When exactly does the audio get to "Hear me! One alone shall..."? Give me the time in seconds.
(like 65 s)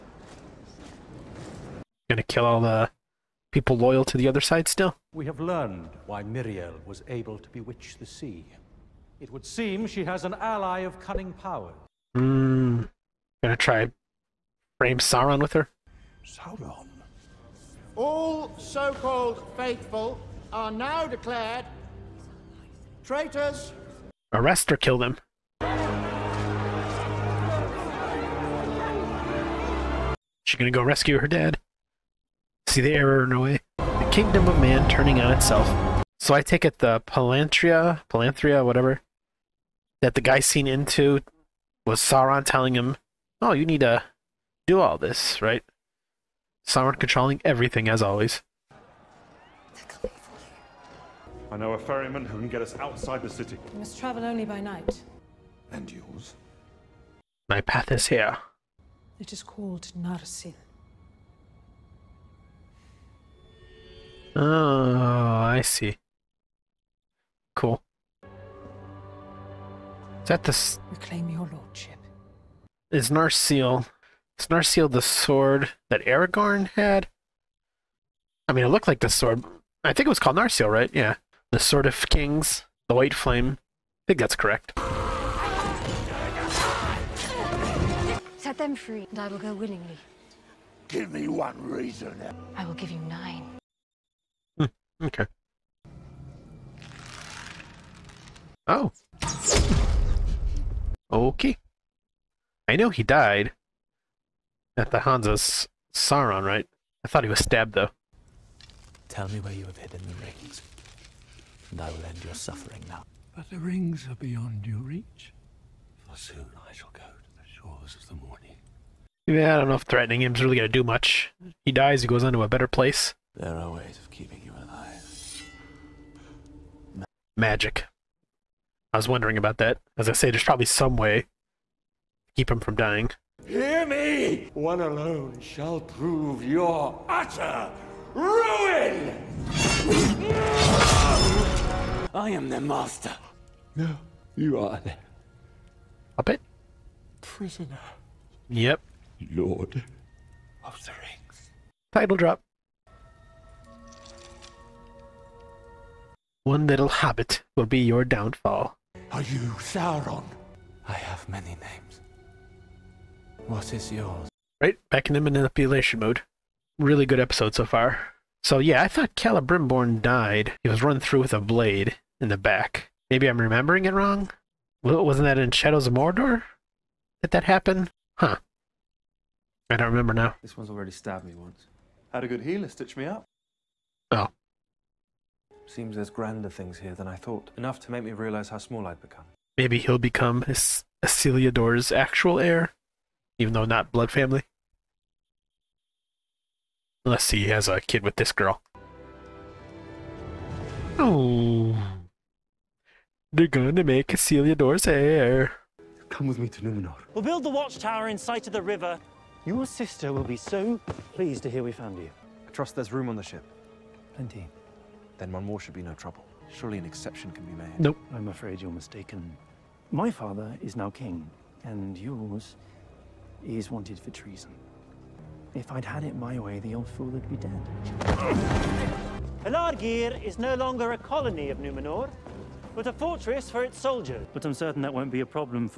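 133 s.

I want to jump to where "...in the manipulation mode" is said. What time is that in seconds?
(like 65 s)
165 s.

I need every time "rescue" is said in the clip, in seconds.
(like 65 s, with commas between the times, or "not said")
30 s.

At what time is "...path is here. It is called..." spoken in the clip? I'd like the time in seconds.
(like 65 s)
57 s.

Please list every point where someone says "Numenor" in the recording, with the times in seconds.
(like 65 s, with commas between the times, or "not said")
206 s, 231 s.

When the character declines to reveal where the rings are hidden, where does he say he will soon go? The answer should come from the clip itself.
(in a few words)
The shores of the morning.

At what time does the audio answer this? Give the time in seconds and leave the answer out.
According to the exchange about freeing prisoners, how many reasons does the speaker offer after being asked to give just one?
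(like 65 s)
92 s.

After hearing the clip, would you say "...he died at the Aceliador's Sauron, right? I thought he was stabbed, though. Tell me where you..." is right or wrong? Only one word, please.
wrong.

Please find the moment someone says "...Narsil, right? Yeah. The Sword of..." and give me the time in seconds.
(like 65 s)
80 s.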